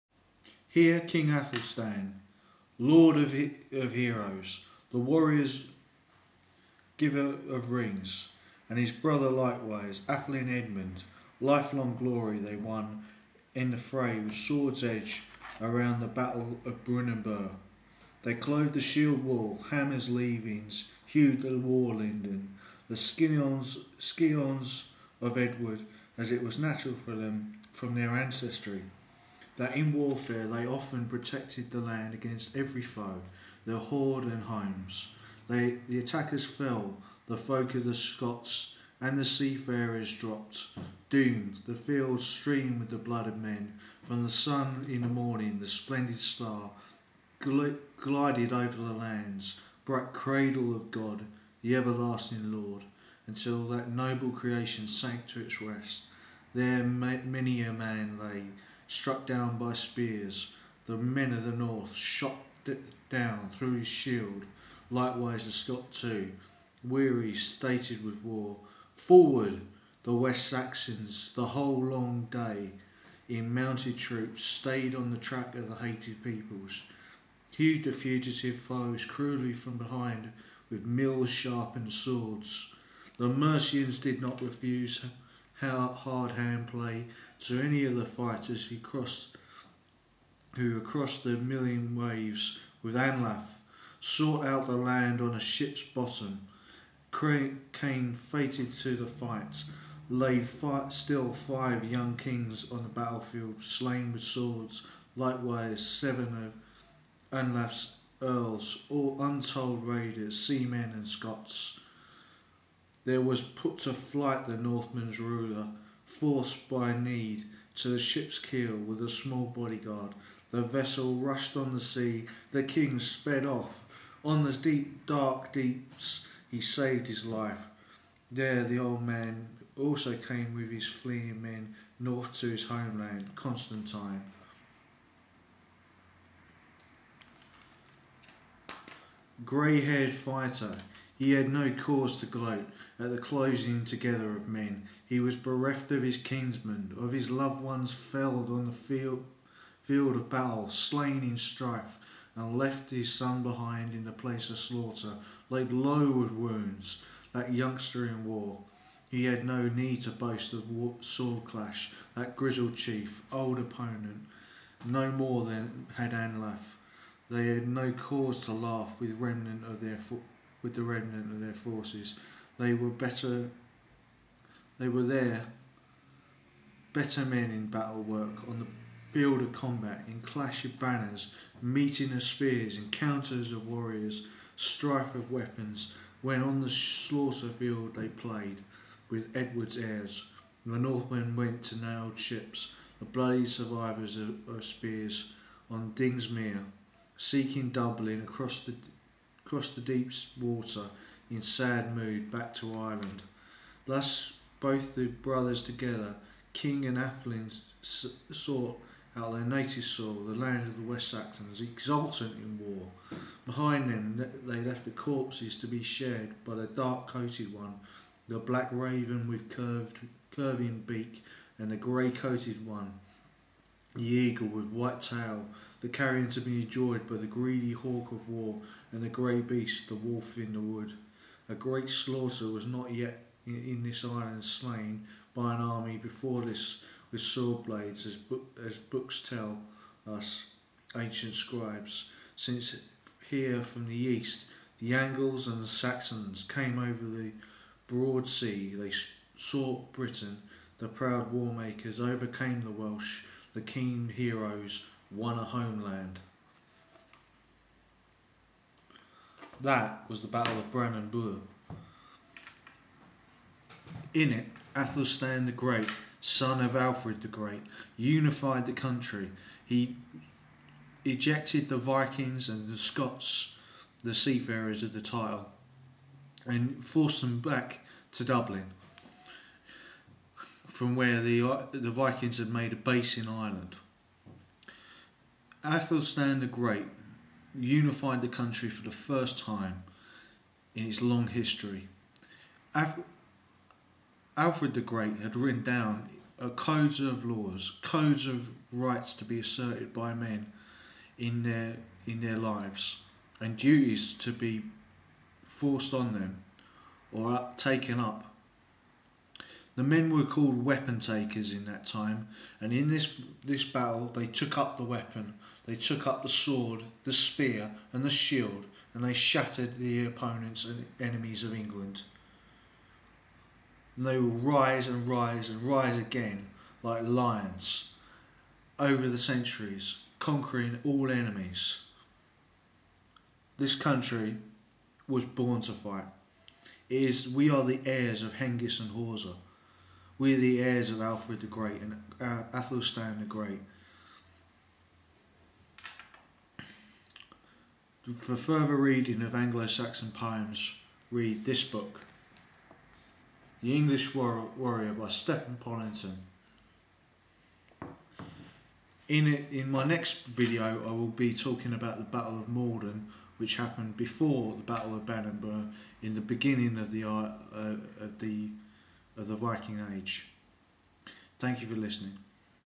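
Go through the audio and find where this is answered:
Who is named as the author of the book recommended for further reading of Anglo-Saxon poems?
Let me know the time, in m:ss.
5:55.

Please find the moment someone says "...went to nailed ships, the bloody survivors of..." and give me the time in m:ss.
3:11.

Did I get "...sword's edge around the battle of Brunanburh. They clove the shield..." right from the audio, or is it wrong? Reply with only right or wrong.
right.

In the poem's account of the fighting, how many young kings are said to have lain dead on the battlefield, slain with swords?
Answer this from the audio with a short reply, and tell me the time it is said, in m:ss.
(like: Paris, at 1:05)
5, at 1:41.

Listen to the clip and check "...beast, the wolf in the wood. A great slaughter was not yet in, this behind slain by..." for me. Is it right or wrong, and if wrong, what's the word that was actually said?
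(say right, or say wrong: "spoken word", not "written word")
wrong: "island", not "behind".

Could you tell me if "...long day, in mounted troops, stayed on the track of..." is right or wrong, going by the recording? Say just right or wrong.
right.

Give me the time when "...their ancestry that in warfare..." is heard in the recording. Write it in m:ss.
0:27.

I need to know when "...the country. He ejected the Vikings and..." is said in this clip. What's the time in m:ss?
4:28.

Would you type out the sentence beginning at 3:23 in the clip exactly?
Thus both the brothers together, King and Atheling, sought out their native soil, the land of the West Saxons, exultant in war.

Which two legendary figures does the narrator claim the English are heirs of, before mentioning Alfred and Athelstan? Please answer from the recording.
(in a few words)
Hengist and Horsa.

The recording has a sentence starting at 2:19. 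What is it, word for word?
Grey haired fighter, he had no cause to gloat at the closing together of men.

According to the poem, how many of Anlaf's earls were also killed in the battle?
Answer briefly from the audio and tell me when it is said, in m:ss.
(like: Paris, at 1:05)
7, at 1:45.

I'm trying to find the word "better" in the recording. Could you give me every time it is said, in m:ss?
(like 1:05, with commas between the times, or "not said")
2:52, 2:56.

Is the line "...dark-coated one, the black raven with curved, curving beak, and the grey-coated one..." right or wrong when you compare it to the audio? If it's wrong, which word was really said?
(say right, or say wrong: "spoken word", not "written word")
right.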